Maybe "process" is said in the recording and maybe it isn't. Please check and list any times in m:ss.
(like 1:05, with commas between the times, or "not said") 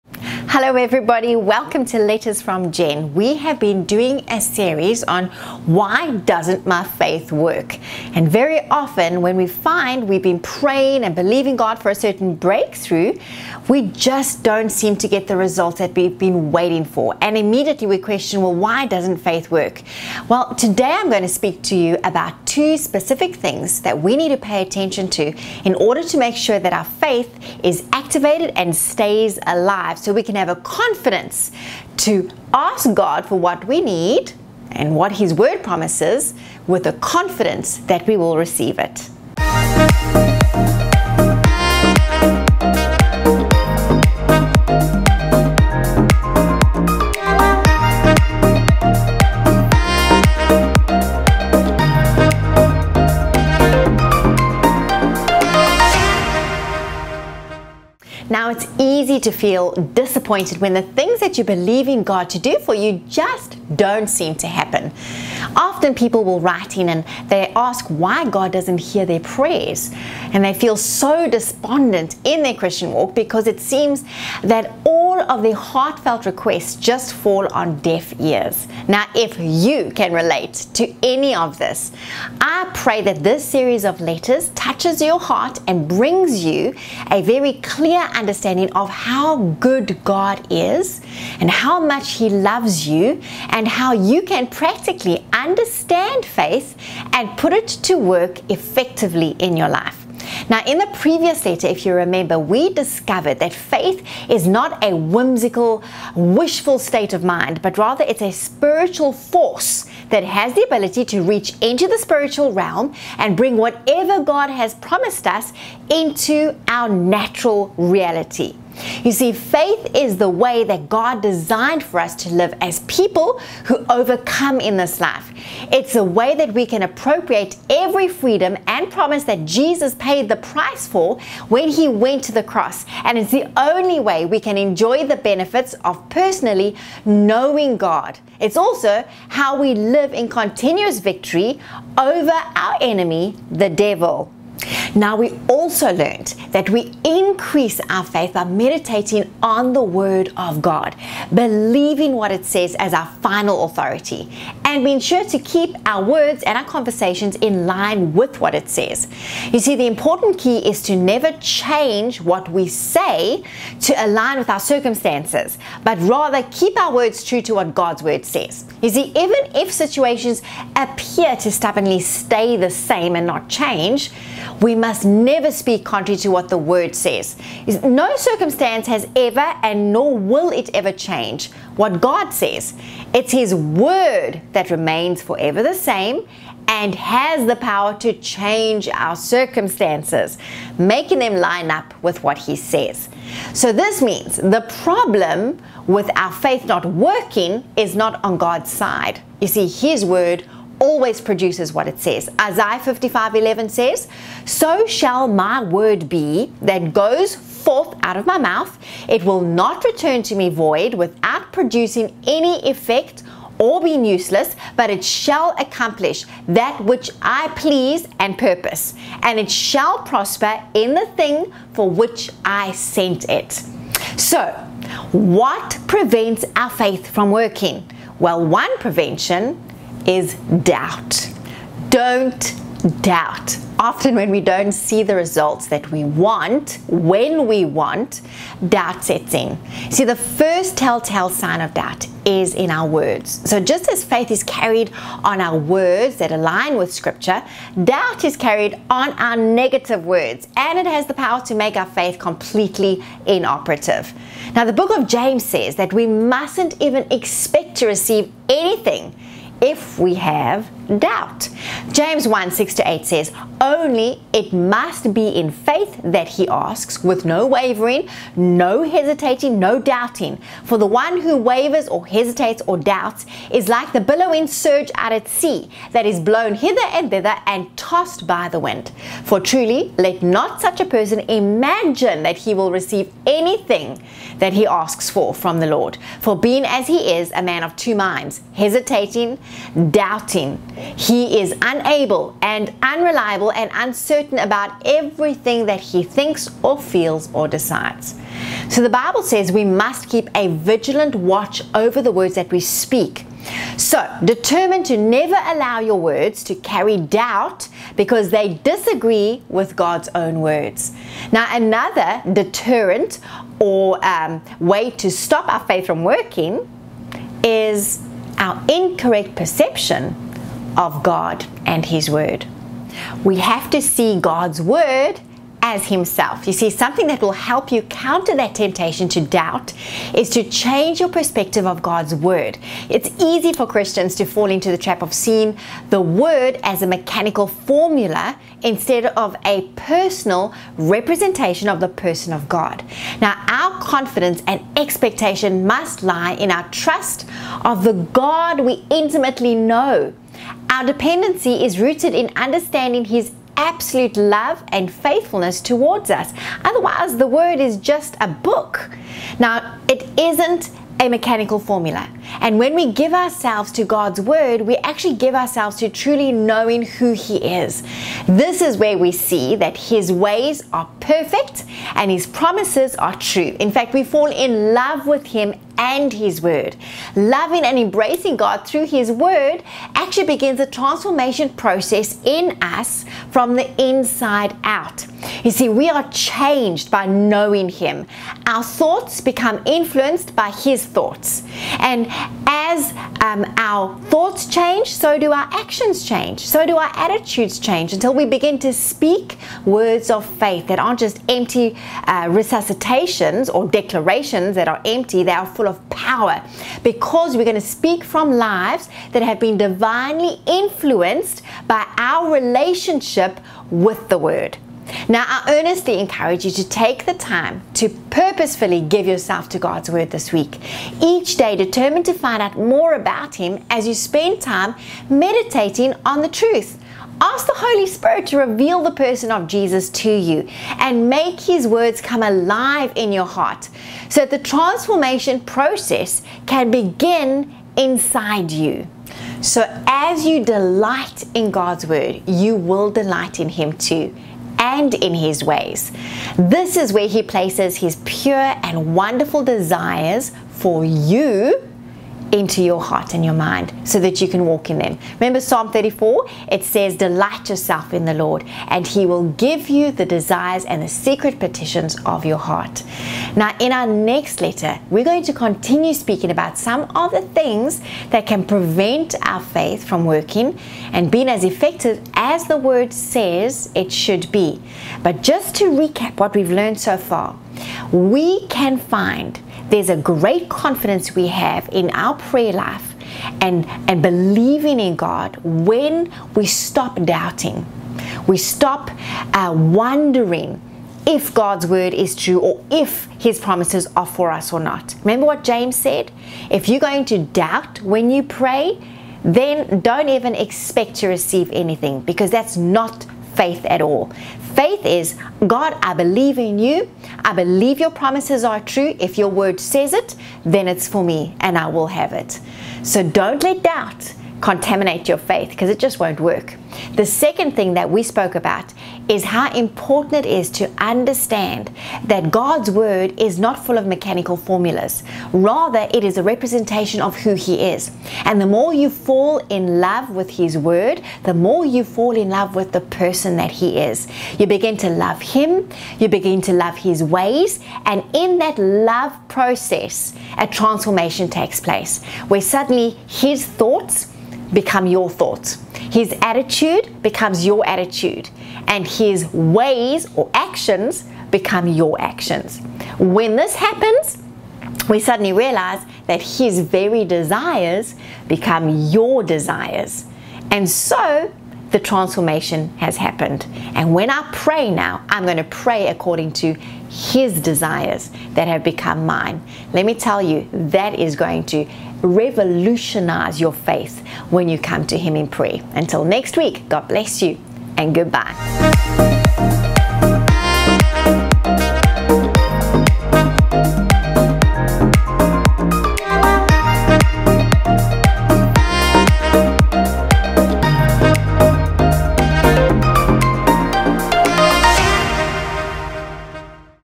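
6:21, 7:15, 8:59.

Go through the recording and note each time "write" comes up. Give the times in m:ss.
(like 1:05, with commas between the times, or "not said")
1:06.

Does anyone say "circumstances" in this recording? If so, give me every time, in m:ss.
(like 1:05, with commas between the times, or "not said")
2:44, 2:58, 3:09.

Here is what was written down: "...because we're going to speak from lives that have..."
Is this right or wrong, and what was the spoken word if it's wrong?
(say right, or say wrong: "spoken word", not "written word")
right.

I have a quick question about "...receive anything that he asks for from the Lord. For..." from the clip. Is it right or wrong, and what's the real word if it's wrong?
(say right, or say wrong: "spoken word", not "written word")
right.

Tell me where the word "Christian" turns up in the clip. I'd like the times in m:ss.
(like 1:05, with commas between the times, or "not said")
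1:12, 5:33.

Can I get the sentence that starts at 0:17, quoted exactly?
And immediately we question, well, why doesn't faith work?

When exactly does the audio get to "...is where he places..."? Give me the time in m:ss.
7:26.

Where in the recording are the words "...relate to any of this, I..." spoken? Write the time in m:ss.
1:20.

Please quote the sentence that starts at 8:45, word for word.
Rather, it is a representation of who He is.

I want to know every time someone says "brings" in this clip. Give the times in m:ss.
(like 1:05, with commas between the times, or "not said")
1:25, 1:53.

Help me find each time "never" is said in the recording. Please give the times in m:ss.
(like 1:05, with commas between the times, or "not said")
2:40, 2:55, 5:04.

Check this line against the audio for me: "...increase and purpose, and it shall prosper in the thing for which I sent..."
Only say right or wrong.
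wrong.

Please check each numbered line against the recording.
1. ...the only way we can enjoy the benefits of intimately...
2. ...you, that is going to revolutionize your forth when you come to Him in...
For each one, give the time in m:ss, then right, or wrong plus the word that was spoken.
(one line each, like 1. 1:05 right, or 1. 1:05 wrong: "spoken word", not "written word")
1. 2:13 wrong: "personally", not "intimately"
2. 9:30 wrong: "faith", not "forth".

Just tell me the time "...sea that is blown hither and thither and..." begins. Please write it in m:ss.
4:35.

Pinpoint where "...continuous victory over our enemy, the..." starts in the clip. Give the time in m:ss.
2:20.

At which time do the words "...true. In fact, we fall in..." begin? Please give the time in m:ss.
6:13.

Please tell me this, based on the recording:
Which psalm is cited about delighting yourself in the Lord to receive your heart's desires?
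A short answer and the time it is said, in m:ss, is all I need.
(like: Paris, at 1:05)
Psalm 34, at 7:35.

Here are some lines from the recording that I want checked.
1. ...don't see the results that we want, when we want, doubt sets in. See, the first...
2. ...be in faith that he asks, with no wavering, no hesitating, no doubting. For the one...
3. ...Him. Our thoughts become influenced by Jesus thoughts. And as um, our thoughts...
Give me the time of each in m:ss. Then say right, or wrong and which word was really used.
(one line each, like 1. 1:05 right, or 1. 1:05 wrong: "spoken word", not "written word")
1. 3:54 right
2. 4:25 right
3. 6:27 wrong: "His", not "Jesus".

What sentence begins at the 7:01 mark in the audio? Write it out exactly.
Each day, determined to find out more about Him as you spend time meditating on the truth.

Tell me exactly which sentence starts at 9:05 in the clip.
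His attitude becomes your attitude, and his ways or actions become your actions.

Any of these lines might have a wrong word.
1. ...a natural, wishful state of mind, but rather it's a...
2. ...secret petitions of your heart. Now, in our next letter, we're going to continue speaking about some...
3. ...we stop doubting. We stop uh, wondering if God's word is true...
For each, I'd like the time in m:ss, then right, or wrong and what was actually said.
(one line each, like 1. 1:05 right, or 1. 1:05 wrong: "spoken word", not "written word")
1. 1:44 wrong: "whimsical", not "natural"
2. 7:40 right
3. 8:06 right.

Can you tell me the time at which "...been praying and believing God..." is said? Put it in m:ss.
0:10.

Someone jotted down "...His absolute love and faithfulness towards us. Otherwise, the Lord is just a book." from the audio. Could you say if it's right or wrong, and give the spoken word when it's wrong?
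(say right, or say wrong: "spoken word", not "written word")
wrong: "Word", not "Lord".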